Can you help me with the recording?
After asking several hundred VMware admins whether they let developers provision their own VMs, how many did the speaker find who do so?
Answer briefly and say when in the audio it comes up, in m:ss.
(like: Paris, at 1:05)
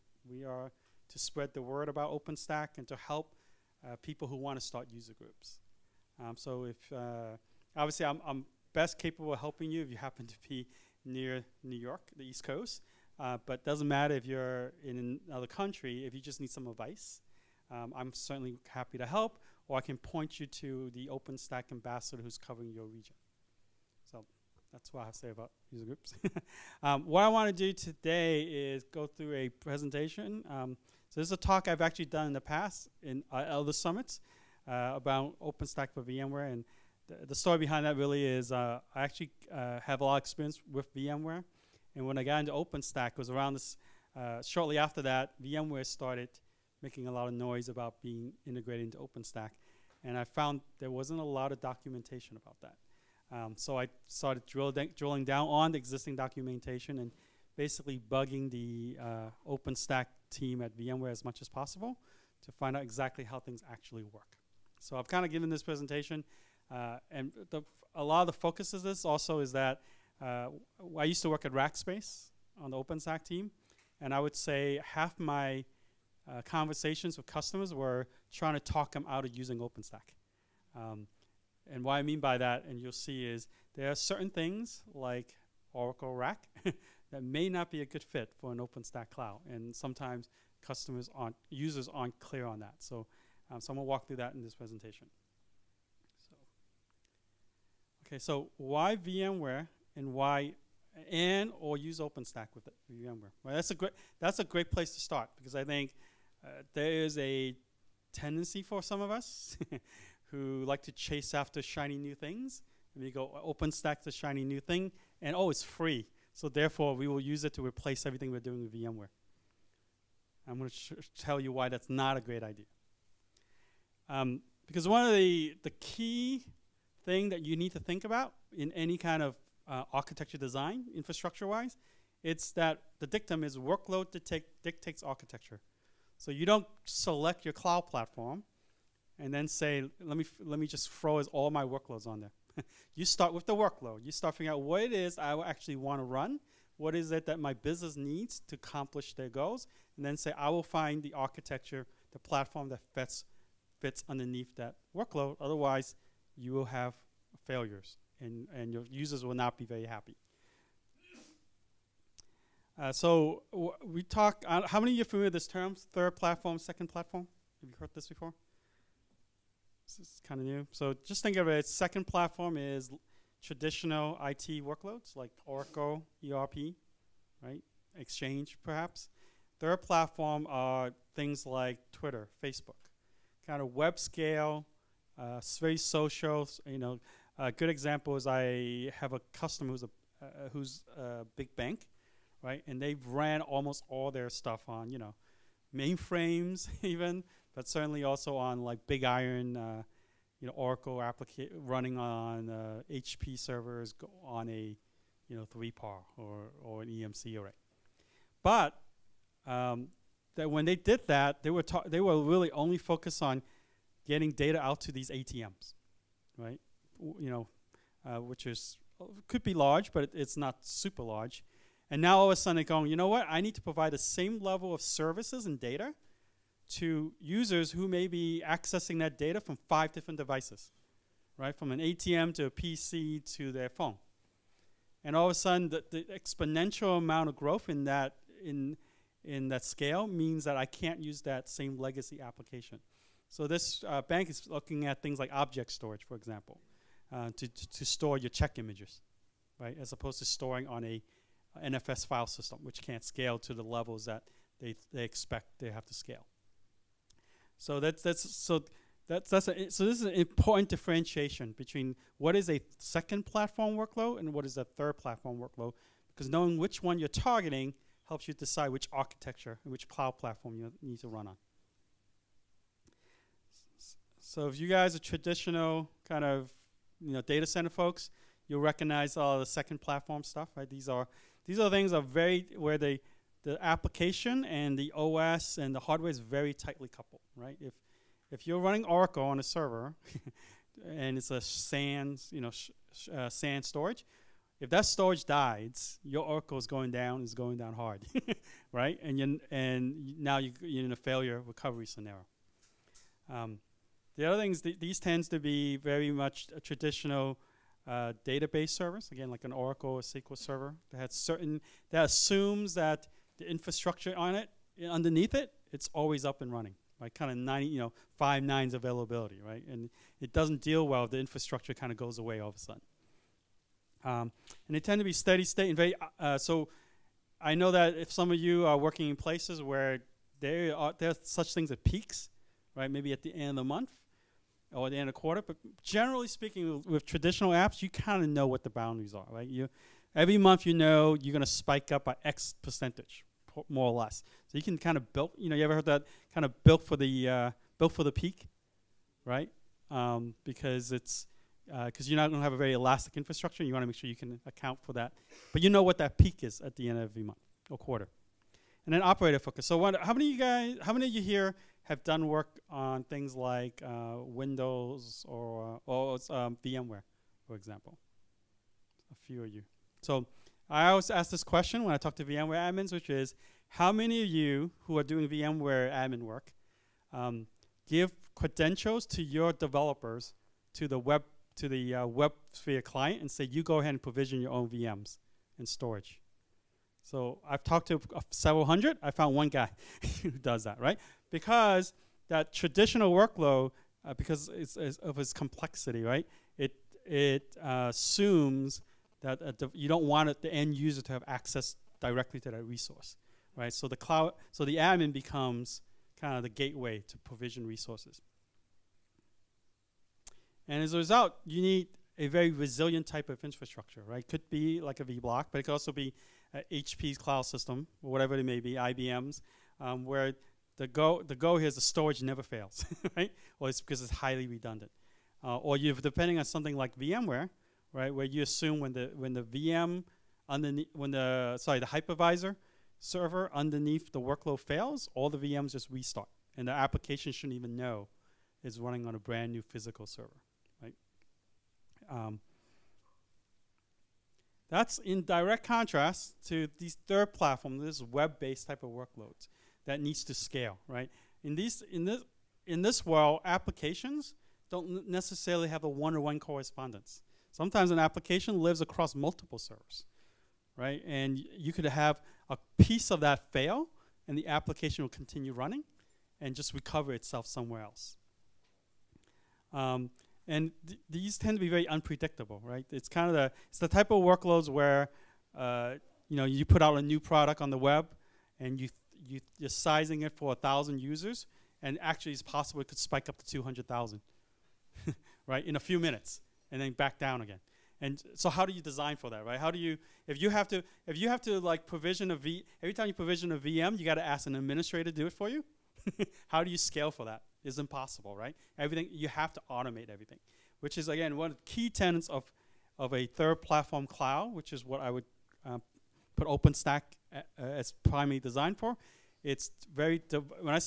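1, at 6:29.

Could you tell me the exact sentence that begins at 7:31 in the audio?
In these in this in this world, applications don't necessarily have a one to -one correspondence.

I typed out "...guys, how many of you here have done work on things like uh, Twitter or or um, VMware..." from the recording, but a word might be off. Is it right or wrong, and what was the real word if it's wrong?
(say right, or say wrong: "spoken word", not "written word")
wrong: "Windows", not "Twitter".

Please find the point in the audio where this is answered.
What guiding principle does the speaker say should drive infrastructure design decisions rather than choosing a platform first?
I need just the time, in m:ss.
2:13.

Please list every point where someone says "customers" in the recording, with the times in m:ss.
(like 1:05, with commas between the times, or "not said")
1:17, 1:30, 3:09.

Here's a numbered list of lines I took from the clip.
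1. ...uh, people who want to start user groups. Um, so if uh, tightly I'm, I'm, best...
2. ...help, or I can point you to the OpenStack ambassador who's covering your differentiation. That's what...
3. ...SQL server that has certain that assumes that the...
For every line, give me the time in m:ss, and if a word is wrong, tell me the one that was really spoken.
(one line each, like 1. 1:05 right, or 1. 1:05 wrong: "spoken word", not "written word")
1. 0:03 wrong: "obviously", not "tightly"
2. 0:19 wrong: "region", not "differentiation"
3. 5:10 right.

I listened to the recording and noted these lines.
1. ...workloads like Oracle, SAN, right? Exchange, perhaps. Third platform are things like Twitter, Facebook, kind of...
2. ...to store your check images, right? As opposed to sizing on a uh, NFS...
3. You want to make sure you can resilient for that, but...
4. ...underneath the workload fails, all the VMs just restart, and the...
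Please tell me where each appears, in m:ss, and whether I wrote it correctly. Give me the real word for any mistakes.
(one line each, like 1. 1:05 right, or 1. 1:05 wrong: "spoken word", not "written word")
1. 2:54 wrong: "ERP", not "SAN"
2. 4:07 wrong: "storing", not "sizing"
3. 5:53 wrong: "account", not "resilient"
4. 7:13 right.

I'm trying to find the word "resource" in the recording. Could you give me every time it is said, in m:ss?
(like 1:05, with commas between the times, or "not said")
6:42, 6:47.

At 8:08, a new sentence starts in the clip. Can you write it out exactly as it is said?
And so how do you design for that, right?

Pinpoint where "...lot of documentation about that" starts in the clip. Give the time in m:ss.
0:51.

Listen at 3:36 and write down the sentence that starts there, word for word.
W- you know, uh, which is could be large, but it, it's not super large.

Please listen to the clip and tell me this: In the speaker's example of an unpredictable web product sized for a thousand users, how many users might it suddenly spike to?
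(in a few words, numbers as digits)
200,000.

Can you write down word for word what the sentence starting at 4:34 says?
So if you guys are traditional kind of you know data center folks, you'll recognize all the second platform stuff, right?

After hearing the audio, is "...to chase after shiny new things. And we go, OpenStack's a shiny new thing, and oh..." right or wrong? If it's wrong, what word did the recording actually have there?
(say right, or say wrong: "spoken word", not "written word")
right.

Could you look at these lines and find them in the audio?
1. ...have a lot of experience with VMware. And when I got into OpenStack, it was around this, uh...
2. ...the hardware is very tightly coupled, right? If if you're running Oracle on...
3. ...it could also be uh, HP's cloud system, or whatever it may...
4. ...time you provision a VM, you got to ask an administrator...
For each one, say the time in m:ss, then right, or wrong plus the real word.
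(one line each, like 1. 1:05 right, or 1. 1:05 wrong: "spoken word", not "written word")
1. 0:39 right
2. 4:45 right
3. 6:55 right
4. 8:12 right.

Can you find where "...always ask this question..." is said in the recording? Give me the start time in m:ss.
6:10.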